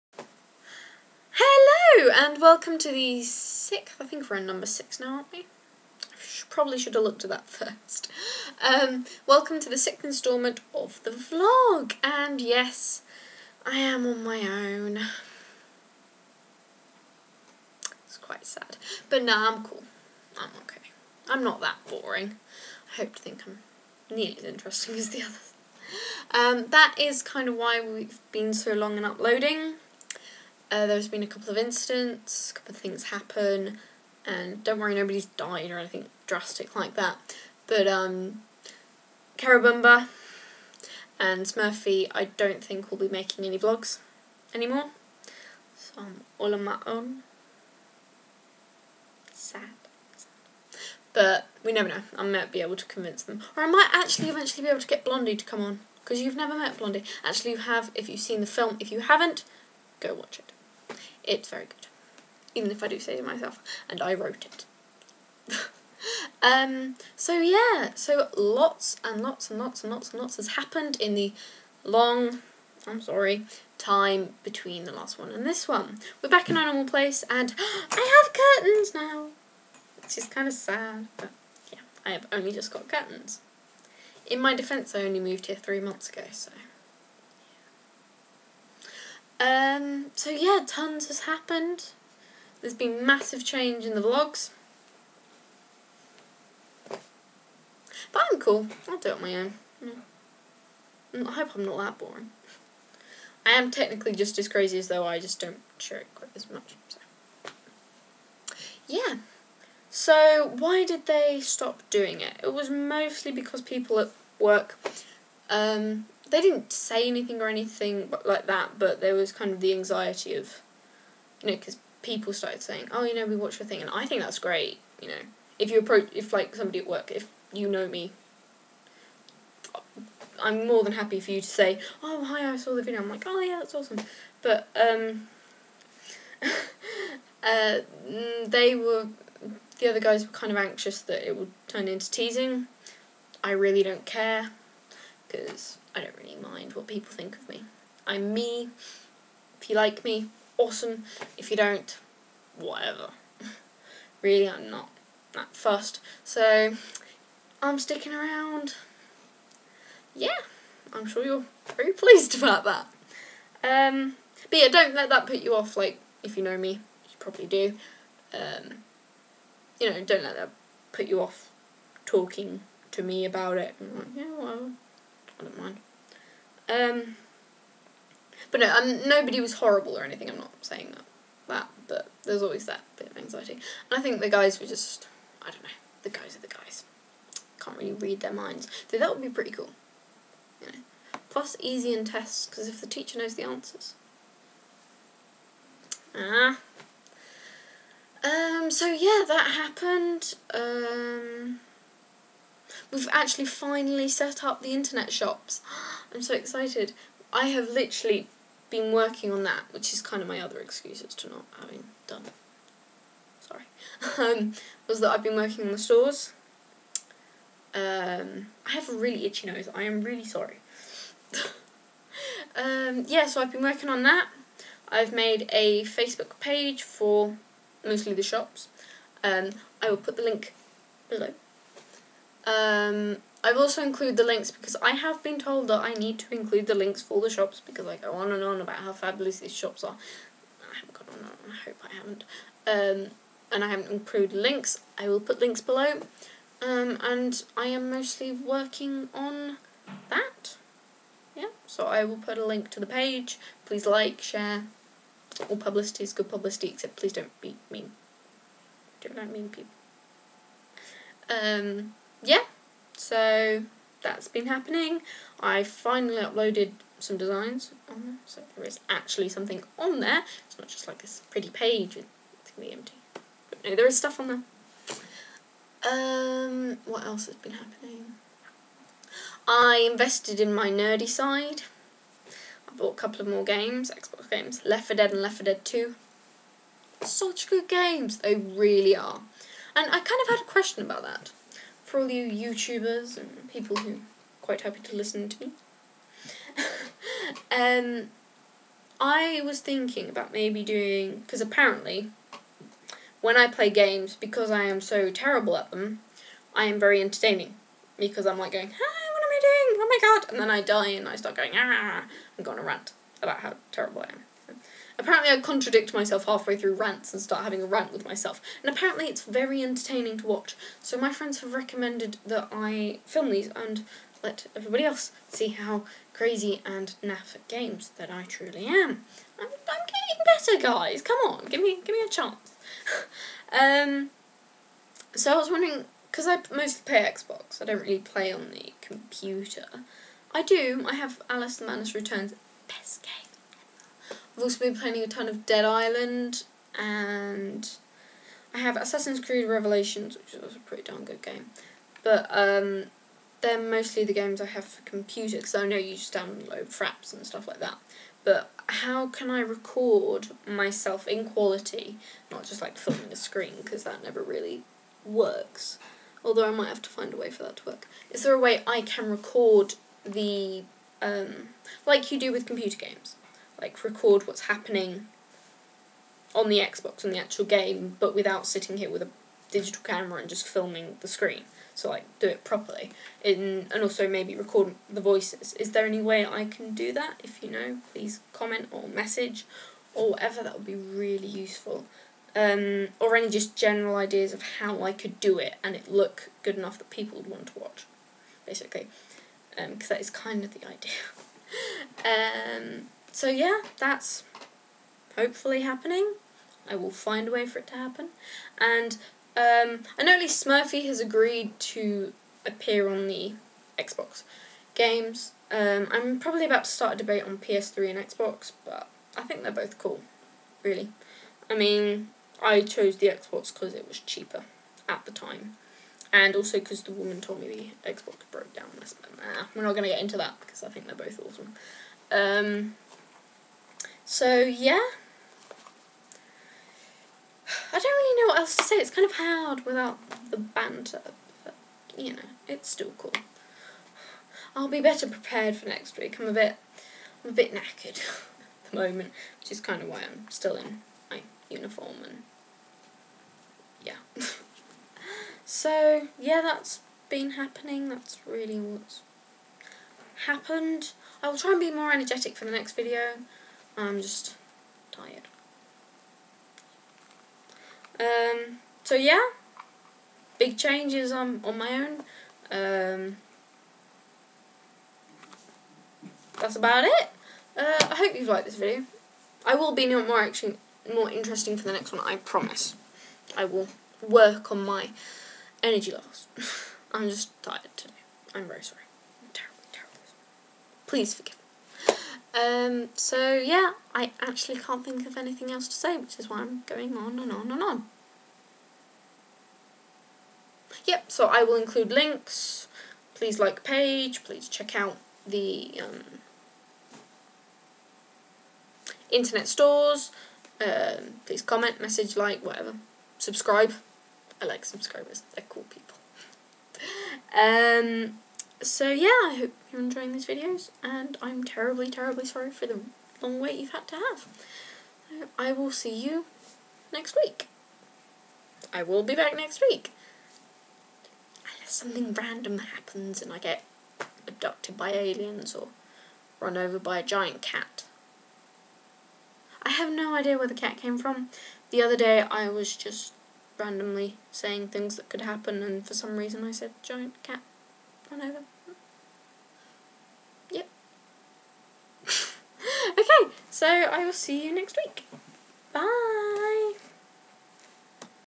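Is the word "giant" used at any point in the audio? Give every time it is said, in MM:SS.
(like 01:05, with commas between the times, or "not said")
08:57, 09:06.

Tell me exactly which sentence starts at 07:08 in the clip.
I said, nah, we're not going to get into that because I think they're both awesome.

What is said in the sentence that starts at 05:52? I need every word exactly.
But um, they're mostly the games I have for computer, because I know you just download fraps and stuff like that.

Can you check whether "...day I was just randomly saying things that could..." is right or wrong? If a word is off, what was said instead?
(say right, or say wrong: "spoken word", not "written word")
right.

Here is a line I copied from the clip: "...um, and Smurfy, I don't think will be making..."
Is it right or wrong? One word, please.
right.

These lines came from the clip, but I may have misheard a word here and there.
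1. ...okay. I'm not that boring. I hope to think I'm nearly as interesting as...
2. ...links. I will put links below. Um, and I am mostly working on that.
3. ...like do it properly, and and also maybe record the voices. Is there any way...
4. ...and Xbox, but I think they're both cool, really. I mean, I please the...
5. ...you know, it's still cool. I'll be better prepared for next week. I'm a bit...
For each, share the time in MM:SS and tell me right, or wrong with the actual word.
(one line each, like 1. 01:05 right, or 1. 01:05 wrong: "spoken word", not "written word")
1. 00:20 right
2. 04:04 right
3. 06:21 right
4. 06:57 wrong: "chose", not "please"
5. 07:21 right.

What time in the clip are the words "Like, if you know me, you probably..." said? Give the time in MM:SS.
02:45.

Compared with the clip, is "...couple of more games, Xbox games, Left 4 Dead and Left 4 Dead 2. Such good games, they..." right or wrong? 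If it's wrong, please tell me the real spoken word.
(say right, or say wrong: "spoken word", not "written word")
right.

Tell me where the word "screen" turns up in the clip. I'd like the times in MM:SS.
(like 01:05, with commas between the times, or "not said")
06:03, 06:21.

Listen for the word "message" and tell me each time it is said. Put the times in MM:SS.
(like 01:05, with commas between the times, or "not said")
06:28, 08:31.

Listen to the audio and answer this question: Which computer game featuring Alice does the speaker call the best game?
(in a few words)
Alice the Madness Returns.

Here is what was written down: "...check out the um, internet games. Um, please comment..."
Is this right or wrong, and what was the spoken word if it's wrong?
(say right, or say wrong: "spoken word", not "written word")
wrong: "stores", not "games".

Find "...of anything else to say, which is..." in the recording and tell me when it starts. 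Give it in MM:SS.
08:15.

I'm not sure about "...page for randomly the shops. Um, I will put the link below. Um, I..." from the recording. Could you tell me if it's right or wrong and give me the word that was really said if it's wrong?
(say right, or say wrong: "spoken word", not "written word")
wrong: "mostly", not "randomly".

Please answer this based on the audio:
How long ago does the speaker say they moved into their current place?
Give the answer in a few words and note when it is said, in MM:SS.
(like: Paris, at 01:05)
three months ago, at 01:25.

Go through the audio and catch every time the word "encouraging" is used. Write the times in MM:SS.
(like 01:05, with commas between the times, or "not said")
not said.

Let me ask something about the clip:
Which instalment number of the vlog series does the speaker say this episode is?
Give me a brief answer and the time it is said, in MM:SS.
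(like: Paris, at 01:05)
6, at 00:04.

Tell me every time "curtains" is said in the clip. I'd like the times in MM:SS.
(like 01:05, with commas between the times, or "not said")
01:18, 01:22.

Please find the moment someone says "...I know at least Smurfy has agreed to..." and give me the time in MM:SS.
06:49.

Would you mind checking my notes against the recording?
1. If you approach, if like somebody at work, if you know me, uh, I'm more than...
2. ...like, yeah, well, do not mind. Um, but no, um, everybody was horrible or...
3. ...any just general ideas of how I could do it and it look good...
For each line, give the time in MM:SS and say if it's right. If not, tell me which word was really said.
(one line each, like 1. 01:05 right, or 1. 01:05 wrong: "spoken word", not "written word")
1. 02:05 right
2. 02:53 wrong: "nobody", not "everybody"
3. 06:33 right.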